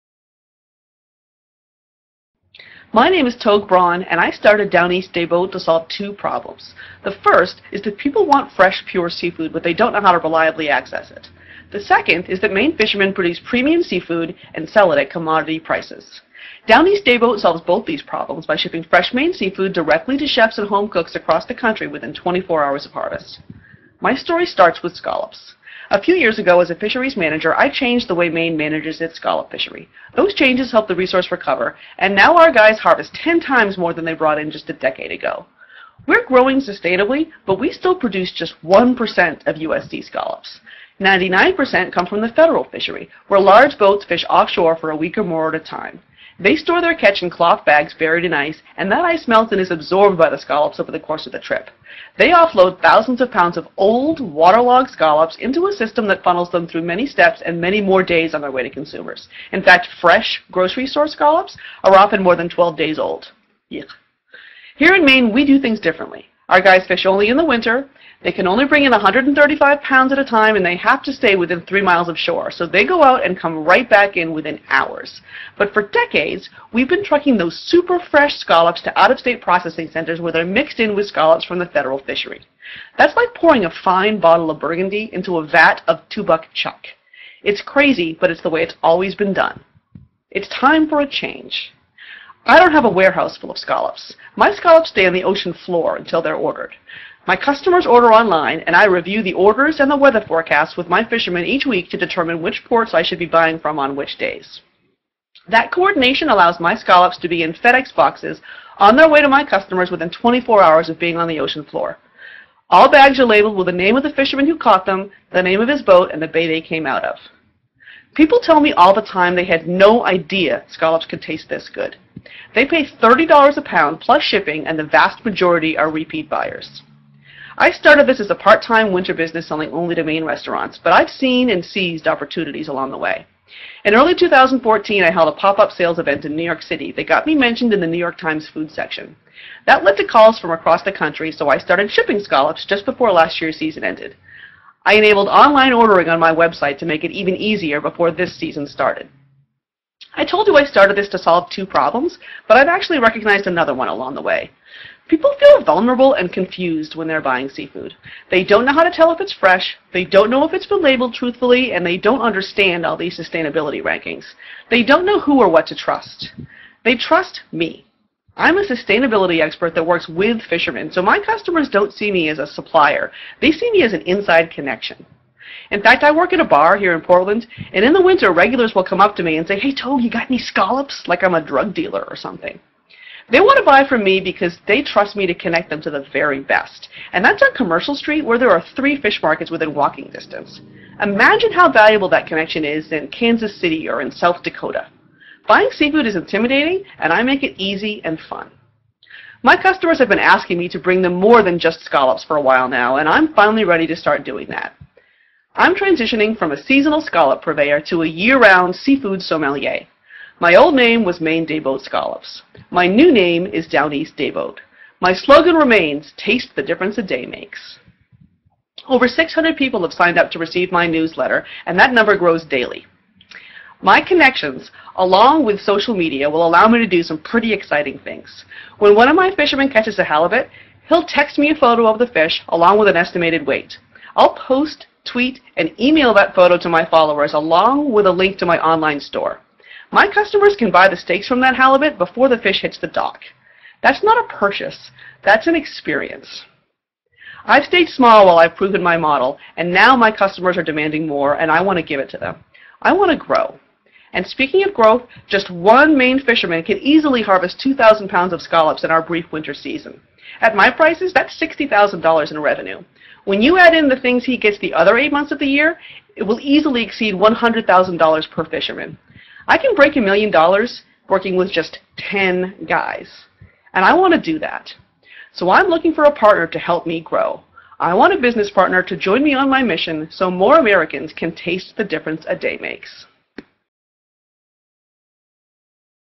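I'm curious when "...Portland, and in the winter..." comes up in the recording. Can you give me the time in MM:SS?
02:57.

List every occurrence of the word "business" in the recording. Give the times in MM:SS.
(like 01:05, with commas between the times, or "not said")
02:09, 04:38.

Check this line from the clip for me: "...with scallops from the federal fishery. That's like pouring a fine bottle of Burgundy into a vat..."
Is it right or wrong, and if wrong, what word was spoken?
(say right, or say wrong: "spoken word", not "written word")
right.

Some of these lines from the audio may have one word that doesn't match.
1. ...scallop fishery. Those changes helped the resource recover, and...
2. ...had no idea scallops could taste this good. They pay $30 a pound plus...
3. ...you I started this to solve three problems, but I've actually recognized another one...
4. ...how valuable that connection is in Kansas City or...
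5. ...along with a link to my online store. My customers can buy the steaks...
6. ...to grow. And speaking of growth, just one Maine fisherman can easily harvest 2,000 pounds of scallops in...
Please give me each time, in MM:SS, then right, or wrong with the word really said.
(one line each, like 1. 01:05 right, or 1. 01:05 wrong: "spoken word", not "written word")
1. 00:29 right
2. 01:59 right
3. 02:30 wrong: "two", not "three"
4. 03:11 right
5. 03:57 right
6. 04:13 right.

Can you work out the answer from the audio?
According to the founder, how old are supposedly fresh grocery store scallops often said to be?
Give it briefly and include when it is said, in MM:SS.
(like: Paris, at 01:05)
more than 12 days, at 01:02.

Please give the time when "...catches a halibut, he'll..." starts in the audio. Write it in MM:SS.
03:49.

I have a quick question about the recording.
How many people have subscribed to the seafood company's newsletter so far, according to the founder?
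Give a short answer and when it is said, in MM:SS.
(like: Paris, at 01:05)
Over 600, at 03:38.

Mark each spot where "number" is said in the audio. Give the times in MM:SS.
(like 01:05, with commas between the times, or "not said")
03:41.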